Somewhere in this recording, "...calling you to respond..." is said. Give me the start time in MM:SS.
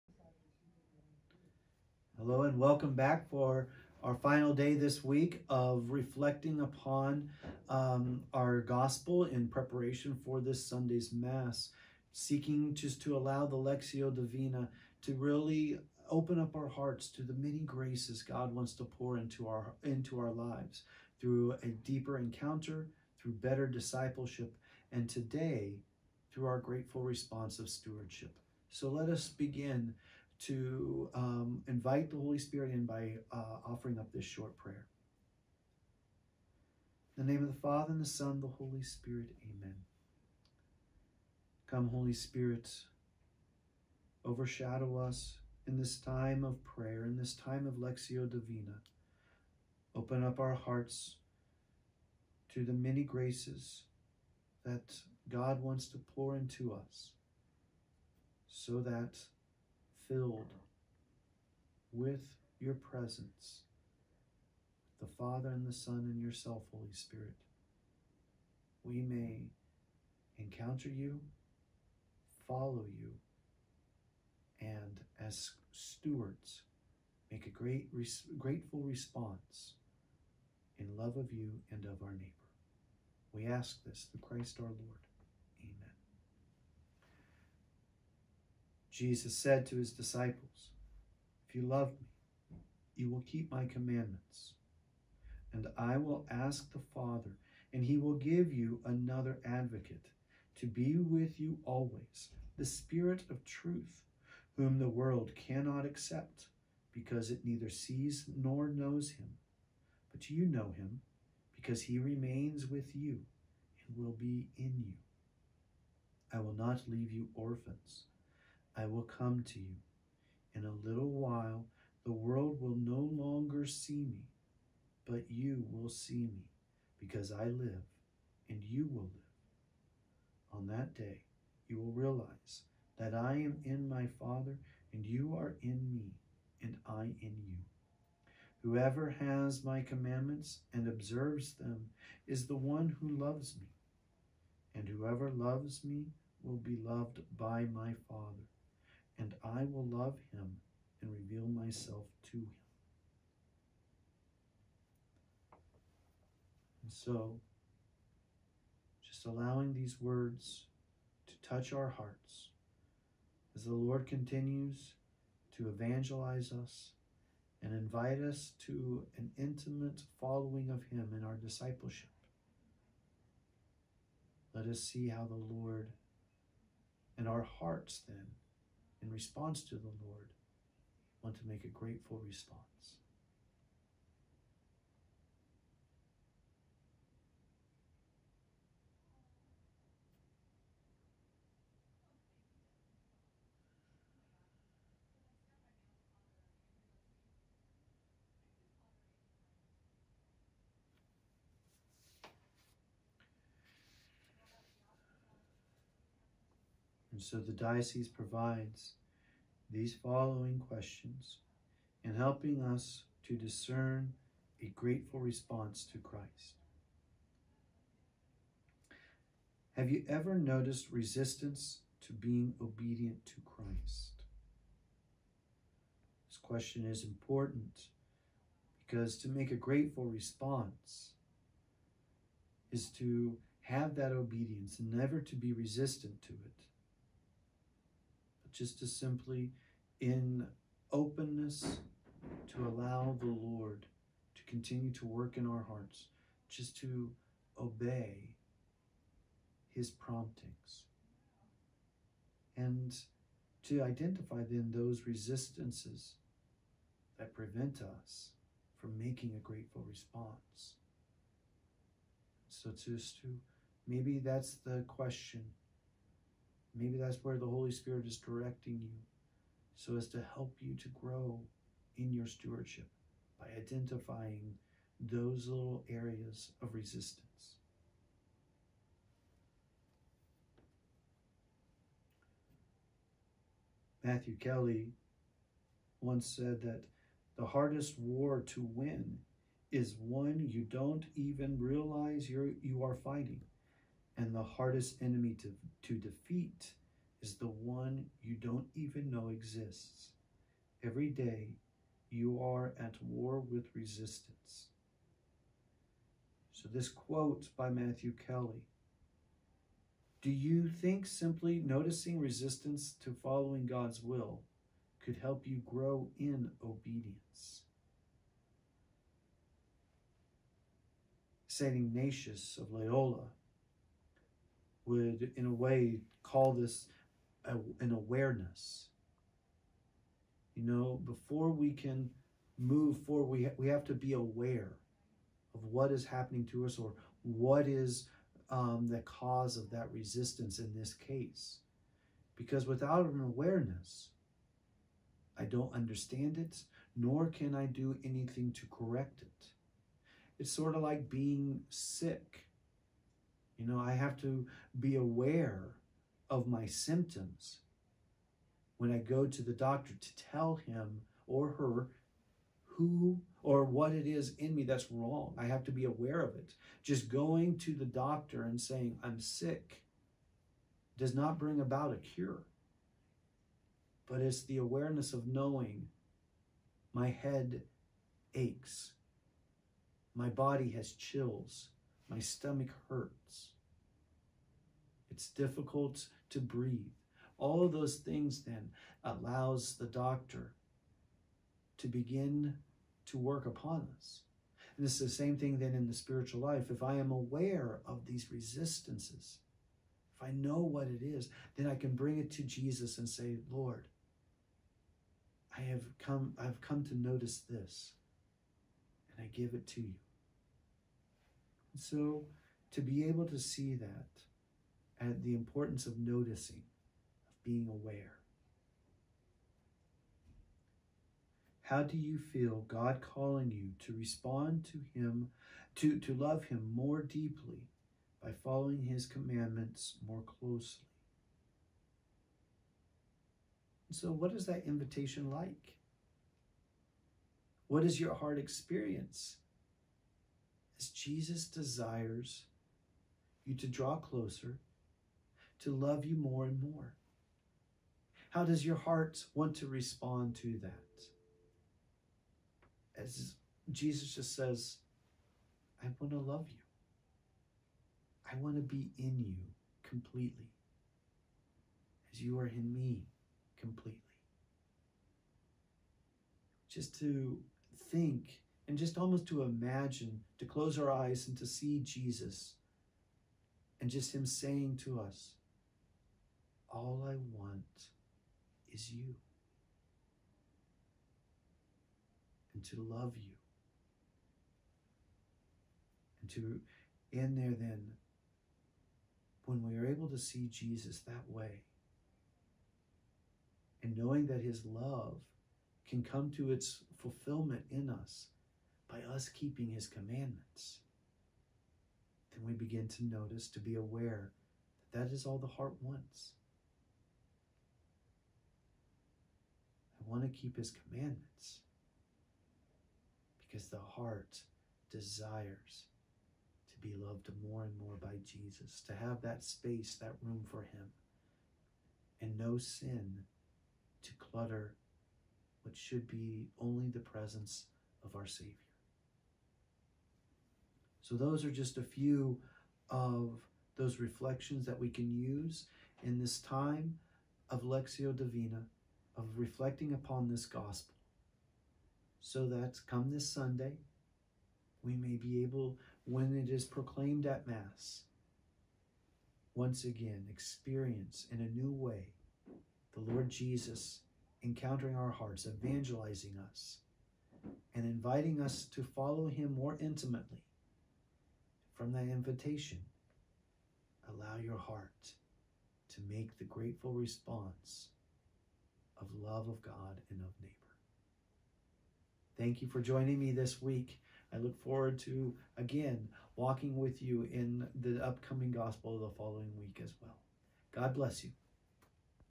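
07:03.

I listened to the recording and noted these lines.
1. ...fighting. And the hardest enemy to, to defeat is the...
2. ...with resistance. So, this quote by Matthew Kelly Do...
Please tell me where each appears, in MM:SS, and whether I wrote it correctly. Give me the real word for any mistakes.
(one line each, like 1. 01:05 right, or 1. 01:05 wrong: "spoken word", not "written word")
1. 04:52 right
2. 05:03 right.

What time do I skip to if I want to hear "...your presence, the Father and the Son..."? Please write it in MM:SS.
01:02.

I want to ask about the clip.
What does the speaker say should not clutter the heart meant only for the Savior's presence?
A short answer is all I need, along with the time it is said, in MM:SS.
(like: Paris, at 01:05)
Sin, at 08:42.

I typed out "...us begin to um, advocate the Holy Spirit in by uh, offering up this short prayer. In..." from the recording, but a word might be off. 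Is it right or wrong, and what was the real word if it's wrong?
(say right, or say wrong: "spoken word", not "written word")
wrong: "invite", not "advocate".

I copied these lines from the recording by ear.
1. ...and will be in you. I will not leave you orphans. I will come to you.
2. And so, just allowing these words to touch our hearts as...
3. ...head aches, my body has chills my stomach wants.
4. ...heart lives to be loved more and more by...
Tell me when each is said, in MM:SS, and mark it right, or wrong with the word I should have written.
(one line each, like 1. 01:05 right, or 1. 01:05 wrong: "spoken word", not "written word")
1. 01:53 right
2. 02:36 right
3. 06:17 wrong: "hurts", not "wants"
4. 08:33 wrong: "desires", not "lives".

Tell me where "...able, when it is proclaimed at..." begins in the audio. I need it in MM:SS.
09:05.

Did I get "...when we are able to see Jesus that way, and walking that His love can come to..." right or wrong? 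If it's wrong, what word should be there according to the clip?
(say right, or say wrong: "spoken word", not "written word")
wrong: "knowing", not "walking".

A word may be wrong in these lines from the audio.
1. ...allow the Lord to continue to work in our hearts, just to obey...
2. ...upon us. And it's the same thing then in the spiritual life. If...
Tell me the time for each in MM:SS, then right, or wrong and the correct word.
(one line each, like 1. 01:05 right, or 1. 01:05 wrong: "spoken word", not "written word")
1. 04:02 right
2. 06:33 right.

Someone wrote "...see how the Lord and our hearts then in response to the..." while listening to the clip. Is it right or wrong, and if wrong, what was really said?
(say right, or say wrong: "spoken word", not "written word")
right.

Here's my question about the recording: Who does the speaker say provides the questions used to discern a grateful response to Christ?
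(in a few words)
The diocese.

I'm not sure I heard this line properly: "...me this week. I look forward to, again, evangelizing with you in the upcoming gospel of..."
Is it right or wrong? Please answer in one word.
wrong.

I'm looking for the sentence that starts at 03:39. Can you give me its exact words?
Have you ever noticed resistance to being obedient to Christ?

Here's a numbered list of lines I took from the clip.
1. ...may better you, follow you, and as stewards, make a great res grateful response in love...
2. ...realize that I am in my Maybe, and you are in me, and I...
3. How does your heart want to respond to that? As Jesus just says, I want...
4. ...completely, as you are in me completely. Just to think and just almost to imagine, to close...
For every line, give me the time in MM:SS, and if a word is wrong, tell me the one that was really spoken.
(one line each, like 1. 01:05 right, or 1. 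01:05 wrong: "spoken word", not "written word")
1. 01:09 wrong: "encounter", not "better"
2. 02:11 wrong: "Father", not "Maybe"
3. 07:28 right
4. 07:39 right.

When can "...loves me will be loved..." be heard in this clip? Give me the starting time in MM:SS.
02:25.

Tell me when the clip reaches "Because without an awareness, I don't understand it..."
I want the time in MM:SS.
05:42.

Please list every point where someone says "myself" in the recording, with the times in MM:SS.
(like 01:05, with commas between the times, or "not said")
02:31.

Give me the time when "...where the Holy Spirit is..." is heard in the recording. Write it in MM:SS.
04:27.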